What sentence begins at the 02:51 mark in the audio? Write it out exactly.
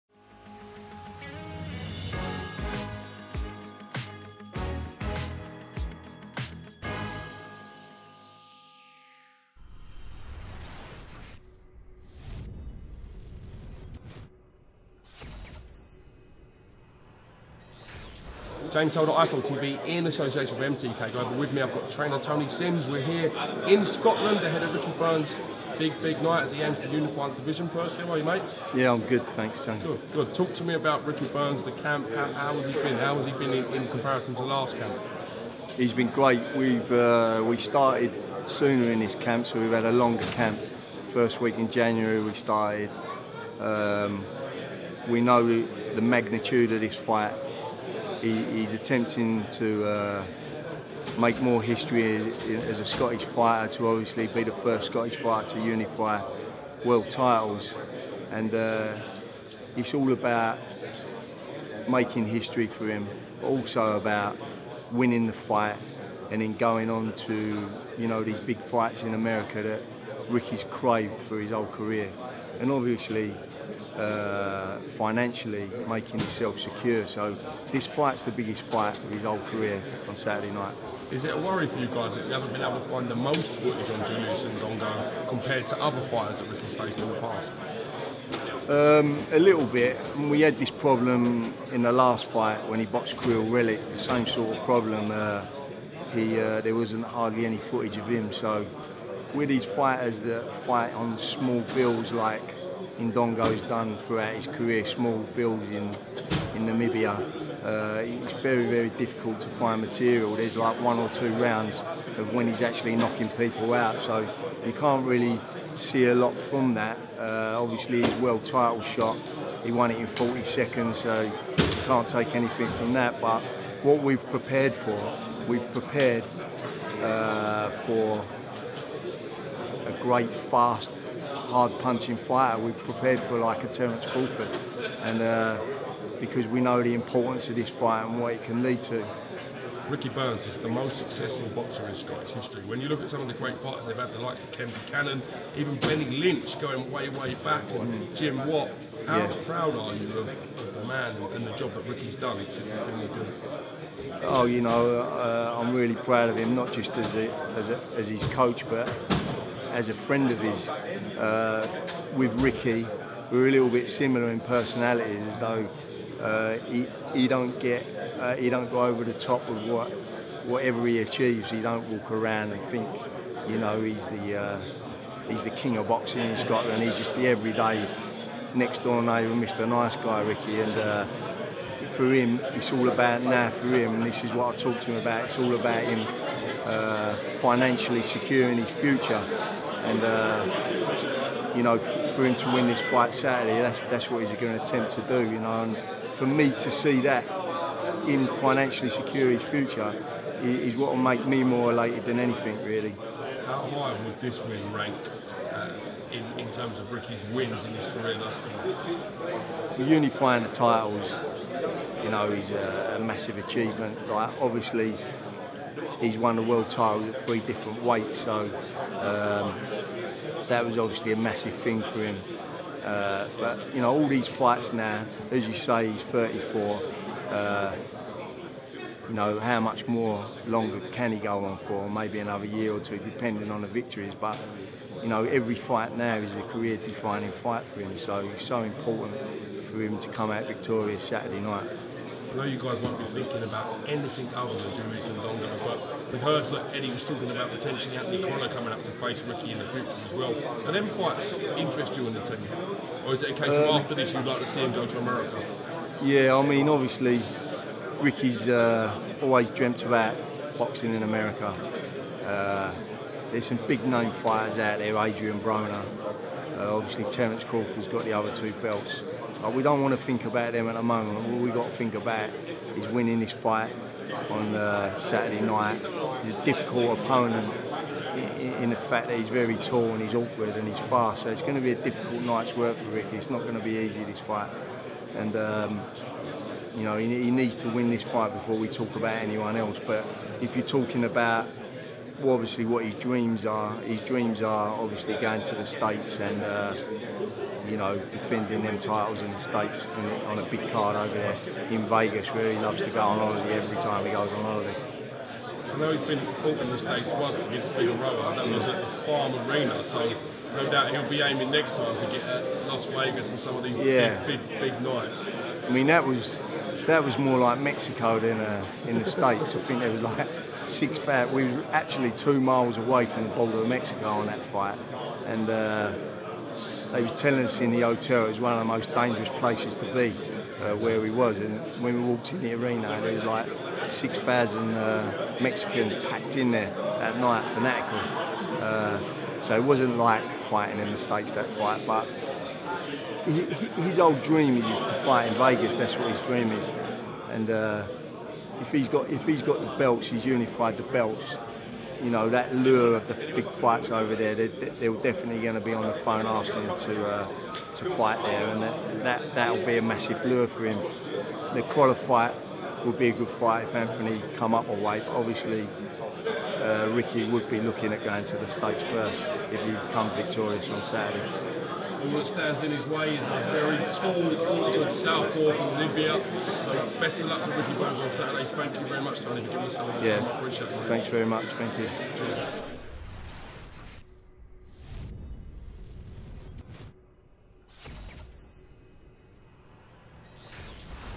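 He don't walk around and think, you know, he's the uh, he's the king of boxing in Scotland.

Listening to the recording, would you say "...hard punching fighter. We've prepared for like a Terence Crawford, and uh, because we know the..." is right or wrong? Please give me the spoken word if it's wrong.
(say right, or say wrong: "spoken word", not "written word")
right.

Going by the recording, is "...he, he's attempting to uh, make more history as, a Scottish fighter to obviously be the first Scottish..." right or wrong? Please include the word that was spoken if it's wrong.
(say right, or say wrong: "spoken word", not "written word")
right.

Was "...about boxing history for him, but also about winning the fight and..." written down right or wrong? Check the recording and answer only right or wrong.
wrong.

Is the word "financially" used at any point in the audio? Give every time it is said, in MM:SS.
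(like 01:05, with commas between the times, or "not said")
01:15, 03:07, 03:18.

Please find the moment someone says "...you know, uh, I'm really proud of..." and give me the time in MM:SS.
02:34.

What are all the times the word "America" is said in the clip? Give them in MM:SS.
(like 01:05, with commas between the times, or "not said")
01:09, 04:14, 04:21.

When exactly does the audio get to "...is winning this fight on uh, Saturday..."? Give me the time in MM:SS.
04:32.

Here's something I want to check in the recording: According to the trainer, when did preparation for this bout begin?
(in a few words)
First week in January.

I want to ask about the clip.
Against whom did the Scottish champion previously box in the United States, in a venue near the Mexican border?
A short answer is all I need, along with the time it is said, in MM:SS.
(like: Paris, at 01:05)
Figueroa, at 05:07.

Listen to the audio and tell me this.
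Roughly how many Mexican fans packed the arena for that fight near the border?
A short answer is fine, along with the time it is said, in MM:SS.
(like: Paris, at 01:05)
6,000, at 05:33.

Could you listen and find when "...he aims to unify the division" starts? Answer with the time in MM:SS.
00:26.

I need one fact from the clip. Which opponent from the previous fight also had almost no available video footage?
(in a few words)
Kiryl Relikh.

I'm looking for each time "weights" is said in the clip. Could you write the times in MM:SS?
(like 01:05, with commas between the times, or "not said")
03:37, 06:04.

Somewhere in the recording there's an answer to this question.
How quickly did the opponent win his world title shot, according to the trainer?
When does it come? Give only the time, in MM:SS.
02:00.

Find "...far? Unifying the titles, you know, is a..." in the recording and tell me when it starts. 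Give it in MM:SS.
03:28.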